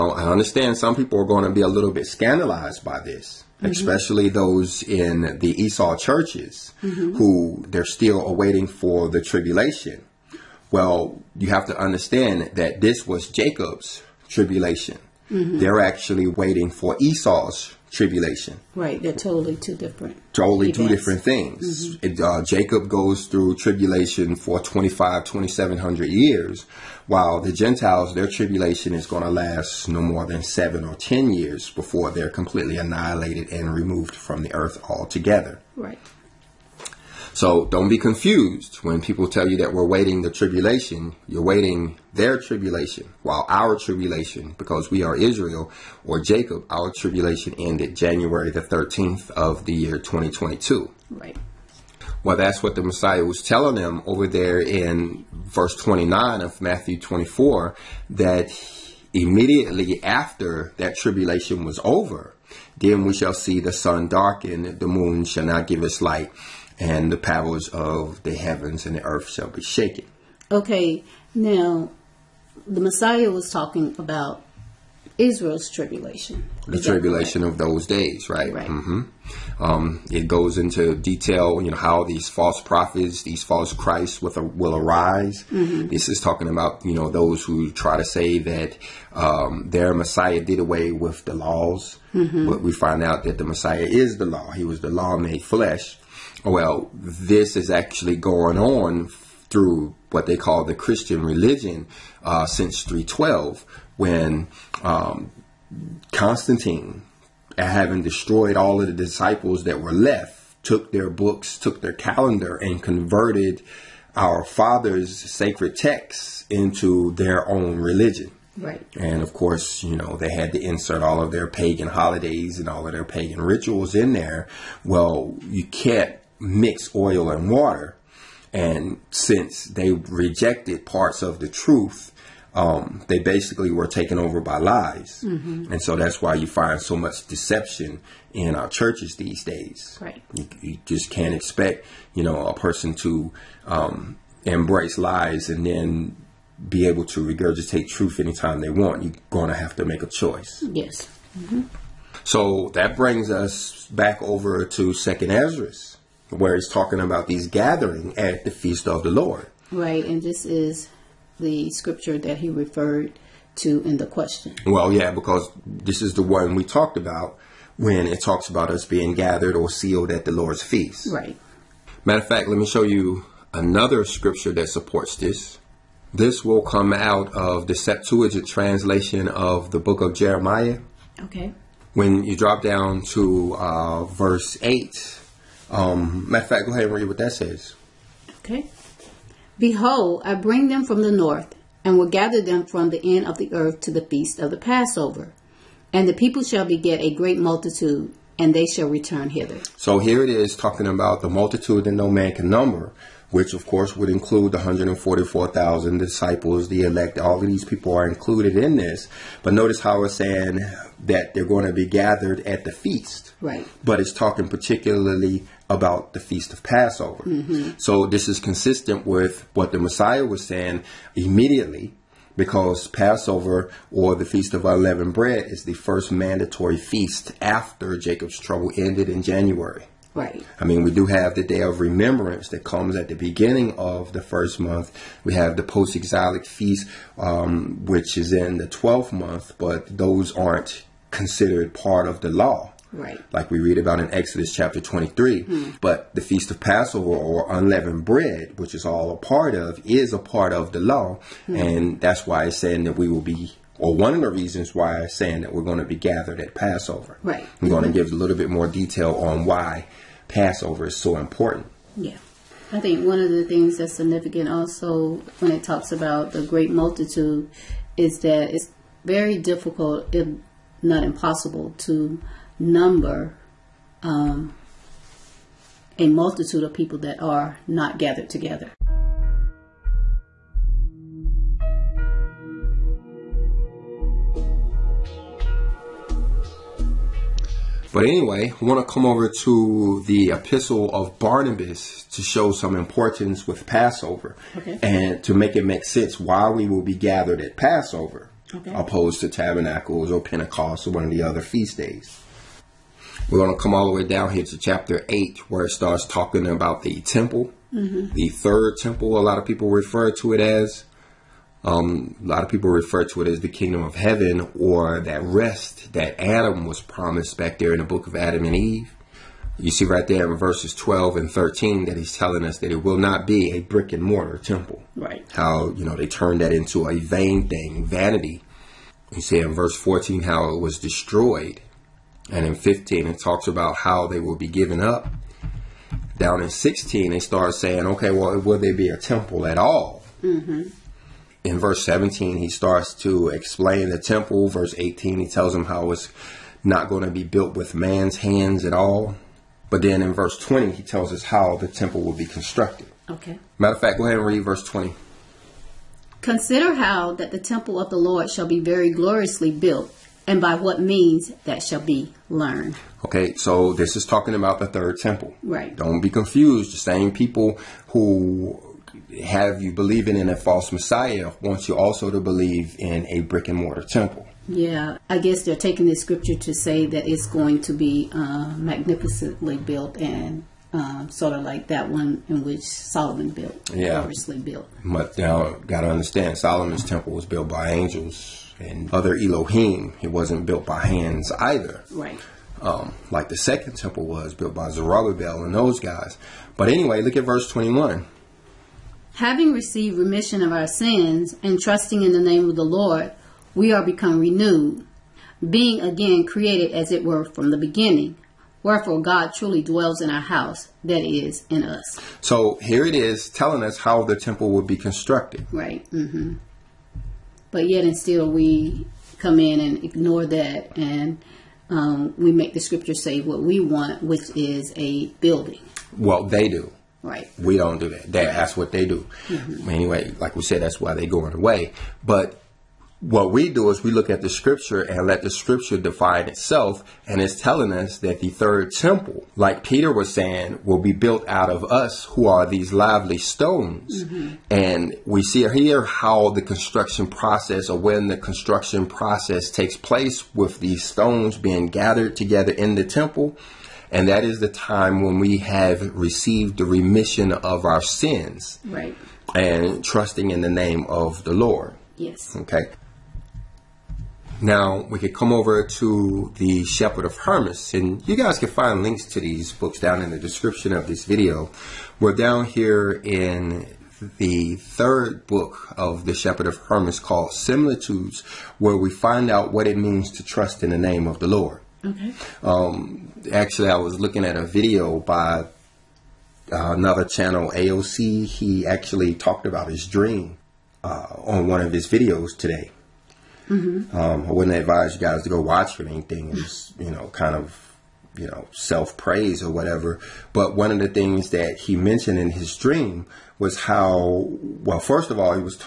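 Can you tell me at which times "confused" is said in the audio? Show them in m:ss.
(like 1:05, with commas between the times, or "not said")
0:37, 6:06.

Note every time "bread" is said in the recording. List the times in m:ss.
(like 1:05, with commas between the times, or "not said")
3:45, 4:08.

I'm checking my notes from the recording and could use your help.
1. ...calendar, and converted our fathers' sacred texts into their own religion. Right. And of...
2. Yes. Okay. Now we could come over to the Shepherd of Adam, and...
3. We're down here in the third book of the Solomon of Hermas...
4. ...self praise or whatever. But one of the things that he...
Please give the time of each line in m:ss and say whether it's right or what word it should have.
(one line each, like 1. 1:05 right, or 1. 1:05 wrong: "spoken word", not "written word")
1. 1:51 right
2. 7:41 wrong: "Hermas", not "Adam"
3. 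7:51 wrong: "Shepherd", not "Solomon"
4. 8:18 right.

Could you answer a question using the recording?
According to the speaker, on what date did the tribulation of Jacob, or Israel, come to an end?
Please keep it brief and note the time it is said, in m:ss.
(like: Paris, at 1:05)
January 13, 2022, at 0:47.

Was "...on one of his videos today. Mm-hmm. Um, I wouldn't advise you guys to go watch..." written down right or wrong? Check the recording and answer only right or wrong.
right.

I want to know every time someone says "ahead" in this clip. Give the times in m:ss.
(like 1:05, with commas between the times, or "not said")
3:06, 5:54.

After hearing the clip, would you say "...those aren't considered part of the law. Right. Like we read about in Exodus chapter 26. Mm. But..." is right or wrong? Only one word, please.
wrong.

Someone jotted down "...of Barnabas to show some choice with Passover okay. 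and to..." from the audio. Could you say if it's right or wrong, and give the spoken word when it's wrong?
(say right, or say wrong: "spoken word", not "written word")
wrong: "importance", not "choice".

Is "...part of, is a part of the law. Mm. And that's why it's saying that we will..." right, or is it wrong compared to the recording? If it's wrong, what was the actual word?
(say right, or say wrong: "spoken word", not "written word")
right.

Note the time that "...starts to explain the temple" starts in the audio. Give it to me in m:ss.
5:42.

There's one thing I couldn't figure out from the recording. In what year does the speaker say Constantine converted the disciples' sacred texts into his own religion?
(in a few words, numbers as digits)
312.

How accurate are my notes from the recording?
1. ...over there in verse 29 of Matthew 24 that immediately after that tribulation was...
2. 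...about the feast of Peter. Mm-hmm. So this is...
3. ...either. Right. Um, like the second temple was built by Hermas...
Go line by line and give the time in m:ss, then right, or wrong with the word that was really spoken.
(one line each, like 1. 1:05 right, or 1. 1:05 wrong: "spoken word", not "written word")
1. 0:54 right
2. 3:35 wrong: "Passover", not "Peter"
3. 6:31 wrong: "Zerubbabel", not "Hermas".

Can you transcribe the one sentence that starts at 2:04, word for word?
Well, you can't mix oil and water.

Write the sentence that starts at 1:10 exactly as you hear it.
Okay, now the Messiah was talking about Israel's tribulation.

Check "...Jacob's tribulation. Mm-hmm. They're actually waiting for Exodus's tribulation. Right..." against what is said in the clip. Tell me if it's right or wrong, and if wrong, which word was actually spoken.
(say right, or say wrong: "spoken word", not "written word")
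wrong: "Esau", not "Exodus".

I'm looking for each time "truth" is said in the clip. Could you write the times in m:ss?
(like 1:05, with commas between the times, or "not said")
2:11, 2:27.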